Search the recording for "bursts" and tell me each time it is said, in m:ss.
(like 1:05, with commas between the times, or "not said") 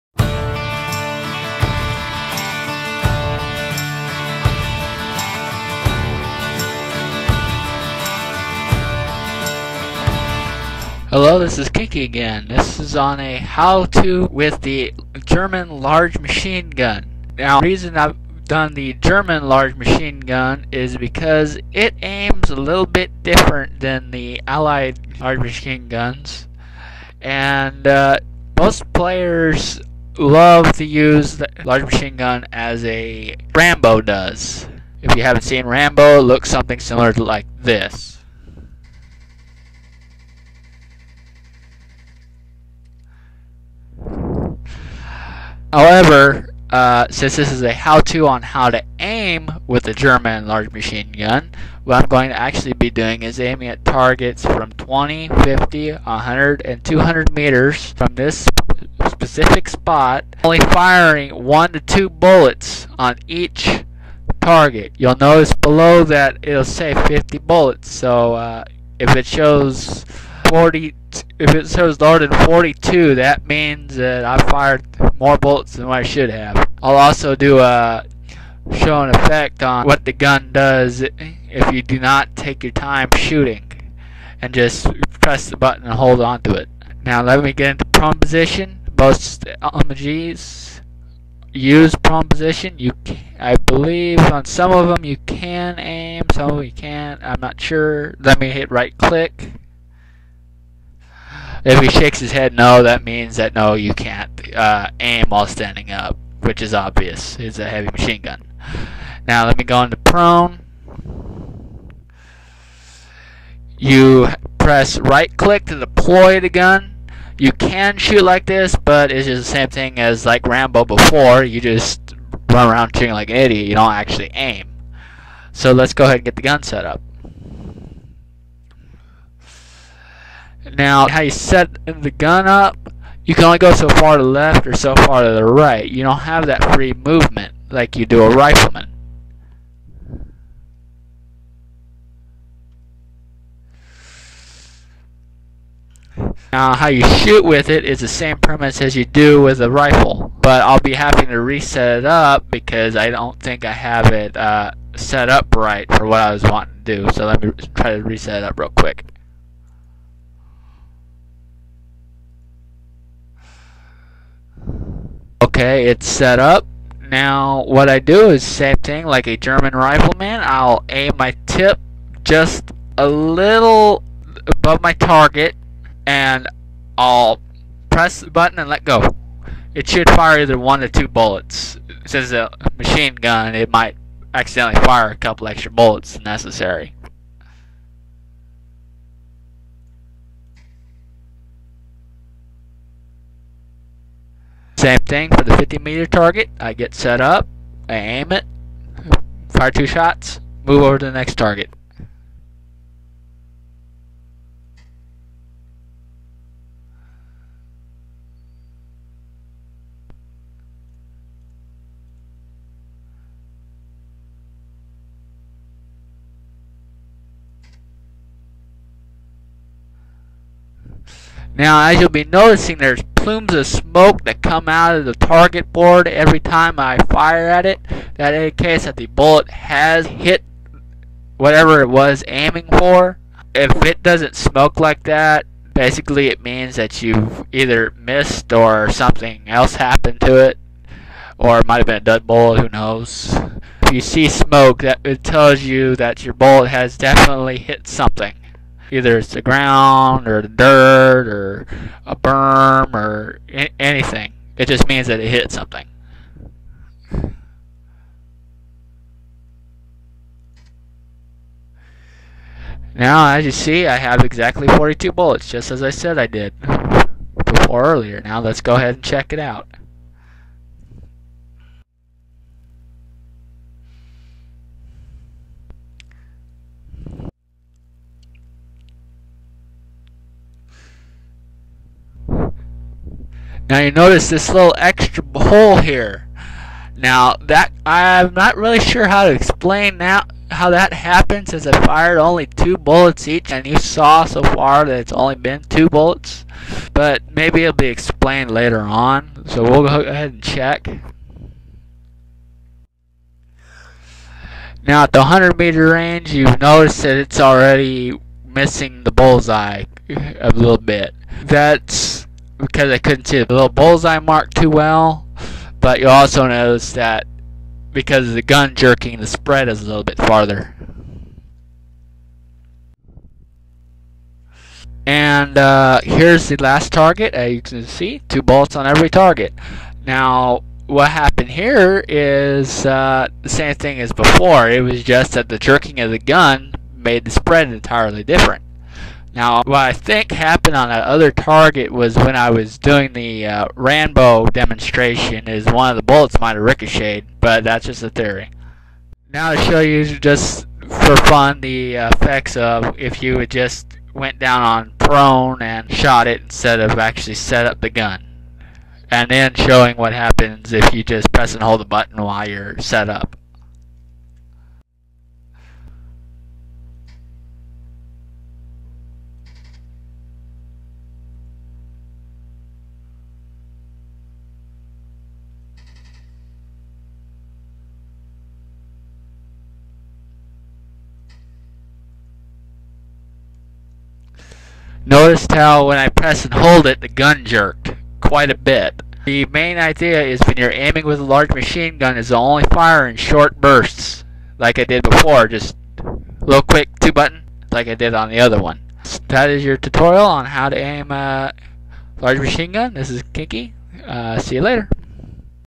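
6:33.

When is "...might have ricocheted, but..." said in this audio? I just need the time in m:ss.
5:46.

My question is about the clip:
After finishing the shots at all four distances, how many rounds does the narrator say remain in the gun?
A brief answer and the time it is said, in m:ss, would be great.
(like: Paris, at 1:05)
42, at 4:24.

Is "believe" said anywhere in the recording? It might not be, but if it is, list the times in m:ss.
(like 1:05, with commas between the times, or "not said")
1:33.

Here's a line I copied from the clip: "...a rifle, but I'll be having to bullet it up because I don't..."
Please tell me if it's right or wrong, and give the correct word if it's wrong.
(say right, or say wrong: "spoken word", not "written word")
wrong: "reset", not "bullet".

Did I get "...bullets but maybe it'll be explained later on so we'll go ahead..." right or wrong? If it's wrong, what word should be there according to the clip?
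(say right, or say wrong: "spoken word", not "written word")
right.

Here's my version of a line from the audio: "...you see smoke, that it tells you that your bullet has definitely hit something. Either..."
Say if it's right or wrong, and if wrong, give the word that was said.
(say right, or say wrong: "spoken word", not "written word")
right.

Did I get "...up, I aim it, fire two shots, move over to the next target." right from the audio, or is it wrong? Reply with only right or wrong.
right.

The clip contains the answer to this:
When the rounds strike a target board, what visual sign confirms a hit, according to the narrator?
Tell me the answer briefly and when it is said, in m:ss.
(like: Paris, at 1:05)
plumes of smoke, at 3:43.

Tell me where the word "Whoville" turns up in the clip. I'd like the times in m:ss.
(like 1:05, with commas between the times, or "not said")
not said.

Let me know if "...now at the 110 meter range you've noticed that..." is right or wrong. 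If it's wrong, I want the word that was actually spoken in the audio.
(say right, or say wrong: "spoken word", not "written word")
wrong: "100", not "110".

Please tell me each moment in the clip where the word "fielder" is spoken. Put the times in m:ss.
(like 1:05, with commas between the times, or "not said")
not said.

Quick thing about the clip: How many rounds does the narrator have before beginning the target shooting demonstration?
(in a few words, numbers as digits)
50.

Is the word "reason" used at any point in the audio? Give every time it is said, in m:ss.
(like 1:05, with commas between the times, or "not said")
0:17.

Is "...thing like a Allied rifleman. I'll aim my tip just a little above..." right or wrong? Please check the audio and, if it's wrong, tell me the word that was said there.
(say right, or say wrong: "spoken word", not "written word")
wrong: "German", not "Allied".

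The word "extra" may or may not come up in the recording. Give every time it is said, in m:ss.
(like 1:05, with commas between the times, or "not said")
3:05, 4:44.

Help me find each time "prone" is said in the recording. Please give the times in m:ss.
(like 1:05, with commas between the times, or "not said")
1:27, 1:32, 1:49, 5:54.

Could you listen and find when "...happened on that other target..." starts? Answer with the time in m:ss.
5:40.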